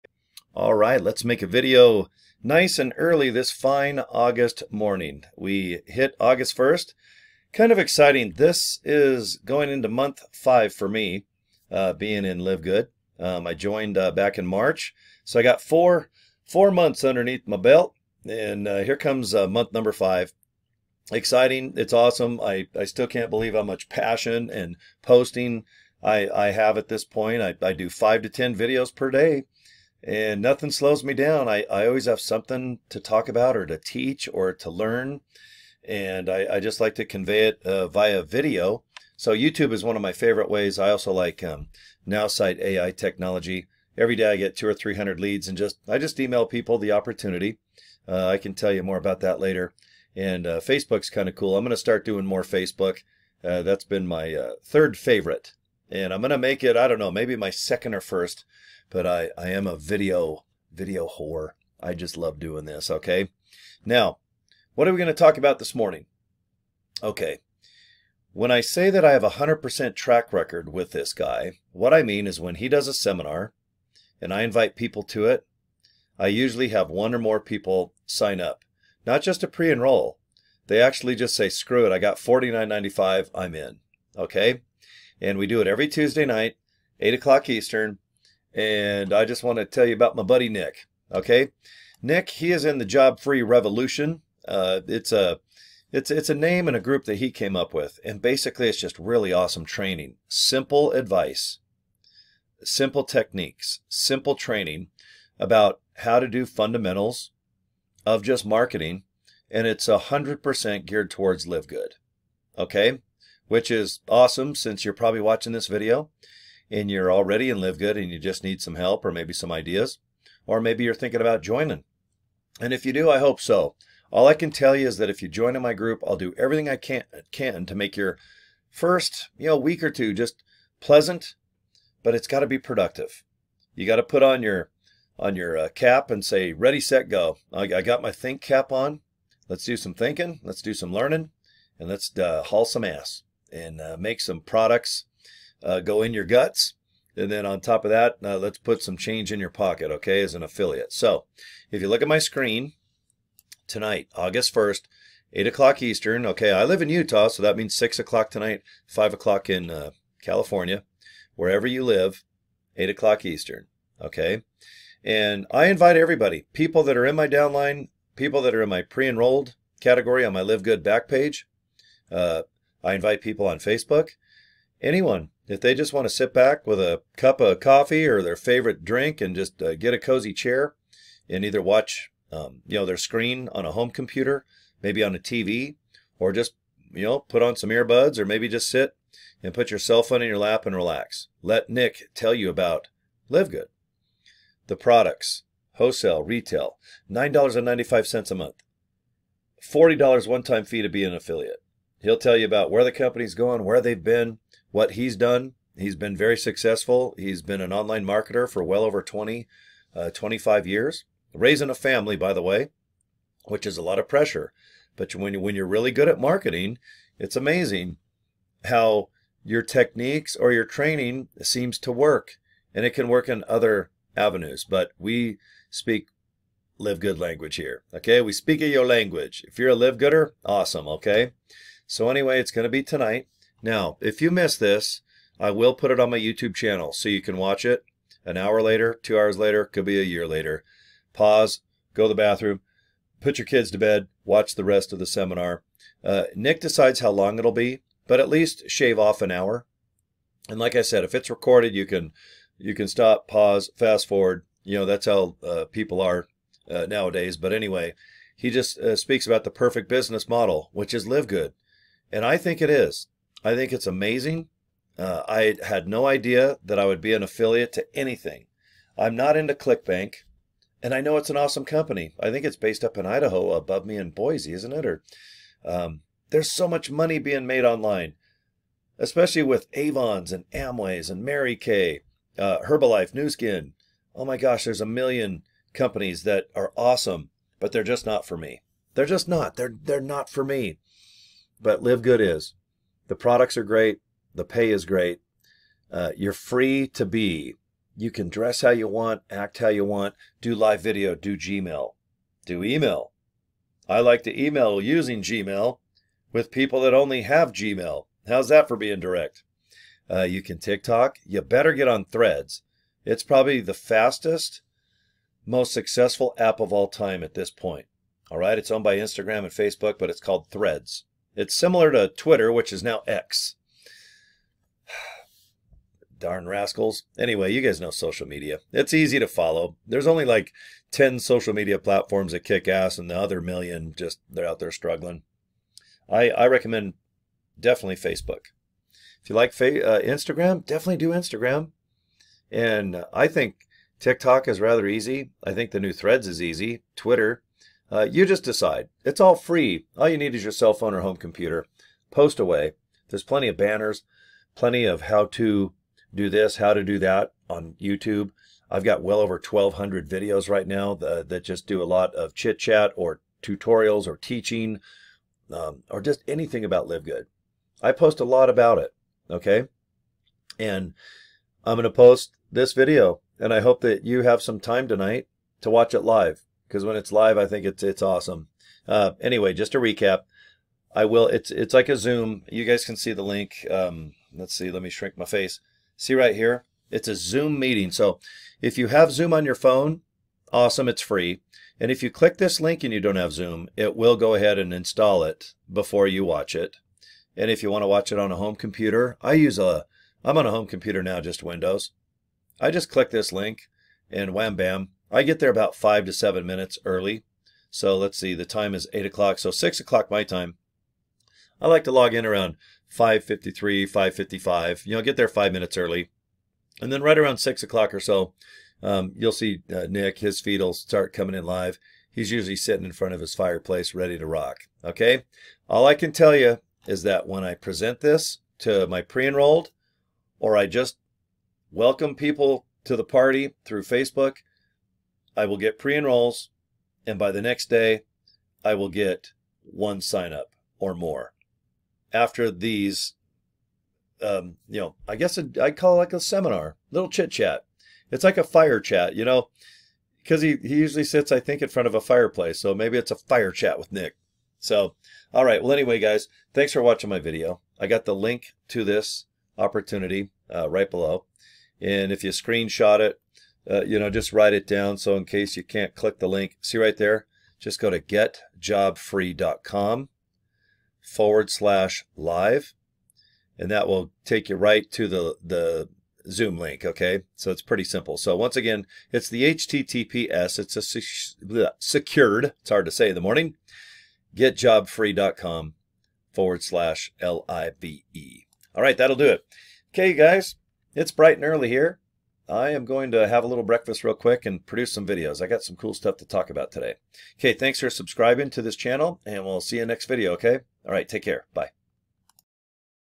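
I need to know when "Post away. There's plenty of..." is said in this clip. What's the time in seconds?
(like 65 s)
352 s.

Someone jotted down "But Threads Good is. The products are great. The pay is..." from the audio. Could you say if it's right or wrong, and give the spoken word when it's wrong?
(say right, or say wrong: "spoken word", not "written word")
wrong: "Live", not "Threads".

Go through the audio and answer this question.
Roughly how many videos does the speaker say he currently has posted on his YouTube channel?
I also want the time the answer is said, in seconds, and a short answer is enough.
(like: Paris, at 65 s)
over 1,200, at 359 s.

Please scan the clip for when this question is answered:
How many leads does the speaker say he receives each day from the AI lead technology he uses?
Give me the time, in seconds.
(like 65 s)
44 s.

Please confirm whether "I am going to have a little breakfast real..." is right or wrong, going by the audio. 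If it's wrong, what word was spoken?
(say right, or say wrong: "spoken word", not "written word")
right.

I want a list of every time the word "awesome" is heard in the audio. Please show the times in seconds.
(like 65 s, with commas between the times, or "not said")
21 s, 99 s, 114 s, 230 s, 271 s, 286 s, 378 s, 390 s.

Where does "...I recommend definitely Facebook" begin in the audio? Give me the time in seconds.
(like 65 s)
336 s.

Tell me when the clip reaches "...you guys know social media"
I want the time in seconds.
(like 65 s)
327 s.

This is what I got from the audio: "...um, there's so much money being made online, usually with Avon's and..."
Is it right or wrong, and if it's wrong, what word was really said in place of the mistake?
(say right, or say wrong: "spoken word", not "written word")
wrong: "especially", not "usually".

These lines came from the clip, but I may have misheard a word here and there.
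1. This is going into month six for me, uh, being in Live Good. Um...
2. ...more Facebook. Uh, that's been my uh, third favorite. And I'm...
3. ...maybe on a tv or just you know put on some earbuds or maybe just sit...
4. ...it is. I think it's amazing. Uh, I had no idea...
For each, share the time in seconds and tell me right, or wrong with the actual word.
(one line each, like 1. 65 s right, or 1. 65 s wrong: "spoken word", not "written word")
1. 8 s wrong: "five", not "six"
2. 52 s right
3. 184 s right
4. 262 s right.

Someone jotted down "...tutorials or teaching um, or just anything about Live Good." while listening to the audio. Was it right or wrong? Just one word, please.
right.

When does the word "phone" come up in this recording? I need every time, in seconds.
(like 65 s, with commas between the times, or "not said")
190 s, 350 s, 389 s.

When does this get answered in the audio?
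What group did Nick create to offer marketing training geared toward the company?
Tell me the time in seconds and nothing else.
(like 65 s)
92 s.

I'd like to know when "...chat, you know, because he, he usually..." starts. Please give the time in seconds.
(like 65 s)
448 s.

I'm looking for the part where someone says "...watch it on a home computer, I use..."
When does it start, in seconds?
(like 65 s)
397 s.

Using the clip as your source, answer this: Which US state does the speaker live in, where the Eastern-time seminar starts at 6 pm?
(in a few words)
Utah.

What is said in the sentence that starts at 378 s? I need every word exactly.
Uh, anyway, just to recap, I will.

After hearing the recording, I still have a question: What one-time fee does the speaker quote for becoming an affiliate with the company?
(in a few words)
$40.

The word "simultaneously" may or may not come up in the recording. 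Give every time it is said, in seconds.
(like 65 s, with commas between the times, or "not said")
not said.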